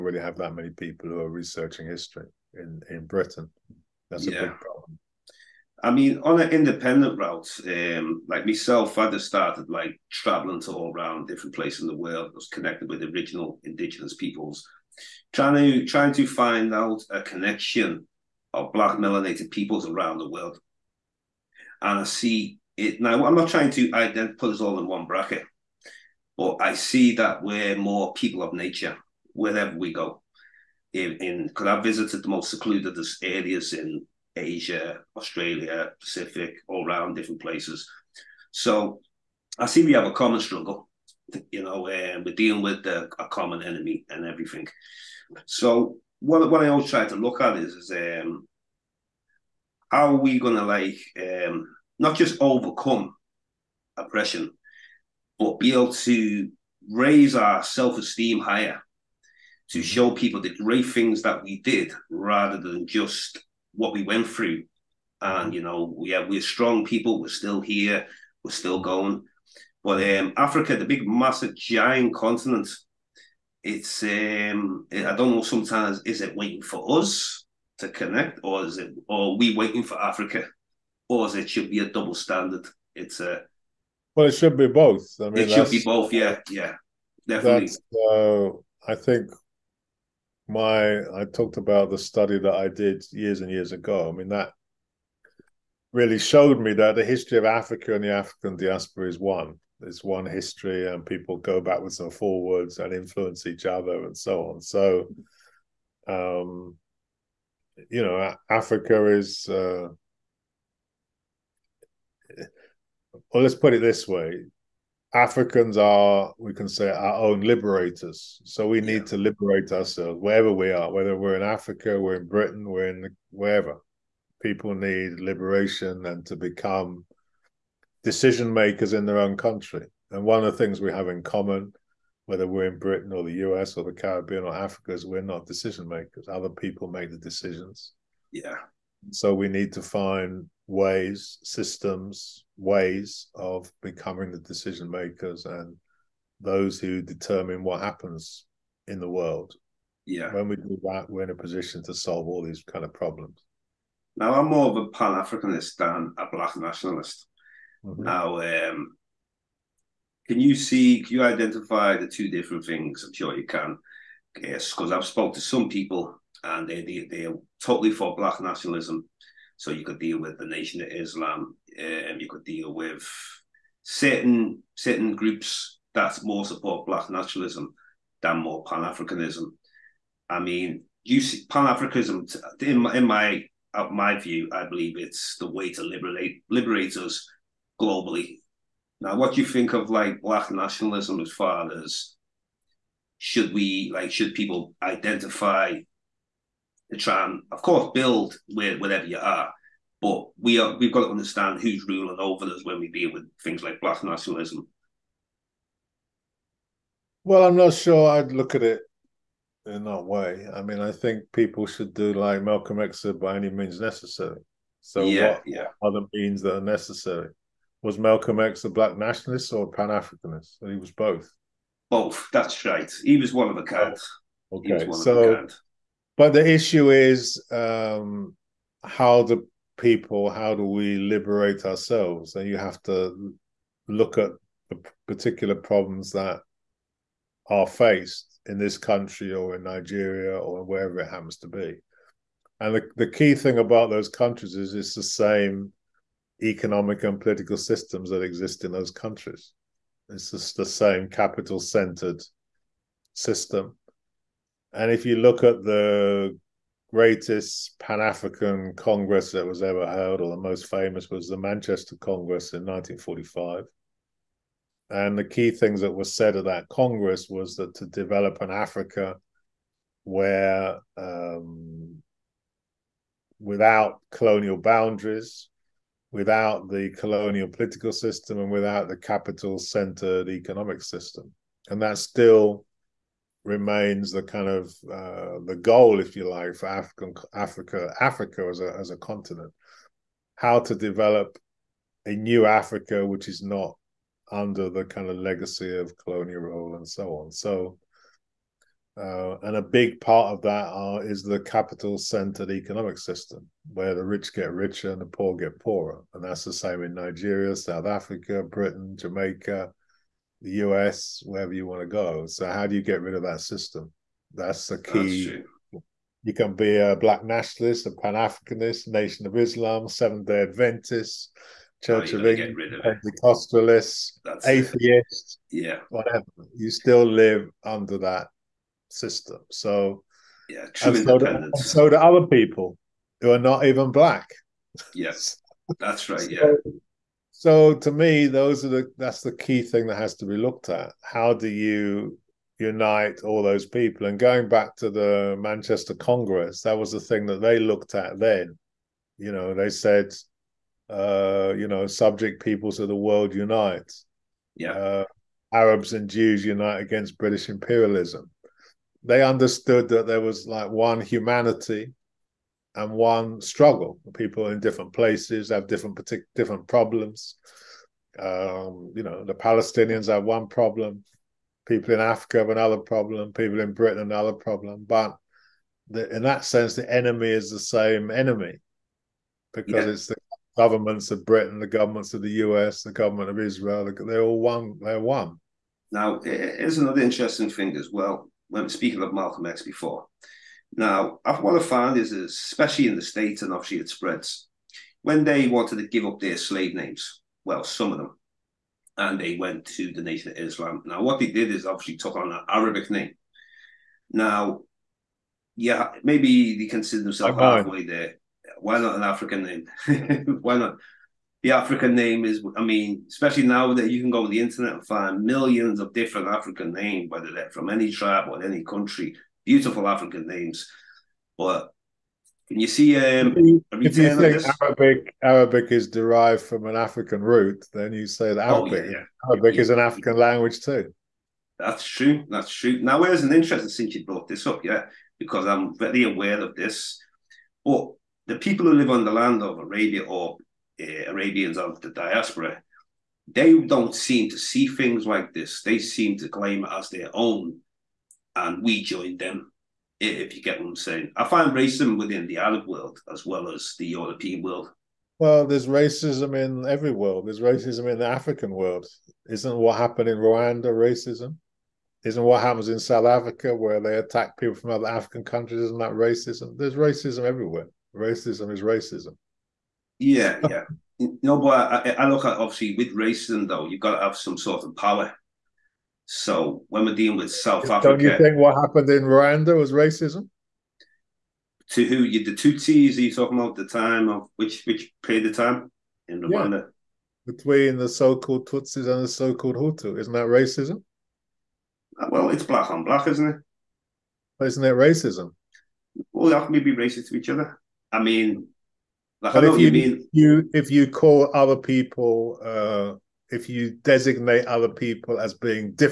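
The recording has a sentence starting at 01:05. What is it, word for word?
you know, yeah, we're strong people.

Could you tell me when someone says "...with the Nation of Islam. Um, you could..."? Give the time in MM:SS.
02:50.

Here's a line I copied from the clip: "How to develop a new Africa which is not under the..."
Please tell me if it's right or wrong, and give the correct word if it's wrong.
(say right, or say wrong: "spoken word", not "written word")
right.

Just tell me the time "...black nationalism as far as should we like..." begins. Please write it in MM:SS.
03:10.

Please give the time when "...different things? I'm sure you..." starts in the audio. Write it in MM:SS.
02:42.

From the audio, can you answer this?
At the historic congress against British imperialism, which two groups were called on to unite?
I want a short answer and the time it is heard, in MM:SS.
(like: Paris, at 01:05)
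Arabs and Jews, at 05:55.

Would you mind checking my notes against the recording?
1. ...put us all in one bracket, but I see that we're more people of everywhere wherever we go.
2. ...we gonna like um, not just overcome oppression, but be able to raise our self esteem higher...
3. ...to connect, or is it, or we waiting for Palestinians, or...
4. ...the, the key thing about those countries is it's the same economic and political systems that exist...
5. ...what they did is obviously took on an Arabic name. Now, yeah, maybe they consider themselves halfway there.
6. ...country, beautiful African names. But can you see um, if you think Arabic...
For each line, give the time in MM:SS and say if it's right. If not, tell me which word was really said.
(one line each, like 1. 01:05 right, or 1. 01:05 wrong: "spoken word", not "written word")
1. 00:24 wrong: "nature", not "everywhere"
2. 00:50 right
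3. 01:17 wrong: "Africa", not "Palestinians"
4. 04:02 right
5. 06:41 right
6. 06:58 right.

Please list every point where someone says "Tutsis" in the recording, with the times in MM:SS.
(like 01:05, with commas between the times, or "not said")
08:08.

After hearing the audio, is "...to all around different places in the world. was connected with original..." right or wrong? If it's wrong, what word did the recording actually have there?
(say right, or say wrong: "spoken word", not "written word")
right.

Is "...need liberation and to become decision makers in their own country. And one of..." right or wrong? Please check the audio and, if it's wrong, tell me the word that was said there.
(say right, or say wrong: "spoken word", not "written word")
right.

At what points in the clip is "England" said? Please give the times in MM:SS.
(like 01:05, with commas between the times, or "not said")
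05:22.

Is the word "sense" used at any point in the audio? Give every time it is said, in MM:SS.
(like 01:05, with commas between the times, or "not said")
06:16.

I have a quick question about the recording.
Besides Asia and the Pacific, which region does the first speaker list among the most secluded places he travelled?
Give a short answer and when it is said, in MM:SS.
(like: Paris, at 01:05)
Australia, at 00:35.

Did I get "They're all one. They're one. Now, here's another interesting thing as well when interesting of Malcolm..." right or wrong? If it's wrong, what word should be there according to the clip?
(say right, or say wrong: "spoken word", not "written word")
wrong: "speaking", not "interesting".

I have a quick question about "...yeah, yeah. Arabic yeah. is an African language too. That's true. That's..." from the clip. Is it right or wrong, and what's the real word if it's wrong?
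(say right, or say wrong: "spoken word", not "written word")
right.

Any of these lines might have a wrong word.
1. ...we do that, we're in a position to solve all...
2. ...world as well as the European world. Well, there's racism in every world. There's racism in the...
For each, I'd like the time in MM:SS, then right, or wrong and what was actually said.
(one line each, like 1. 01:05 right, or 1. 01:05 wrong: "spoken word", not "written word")
1. 02:30 right
2. 07:32 right.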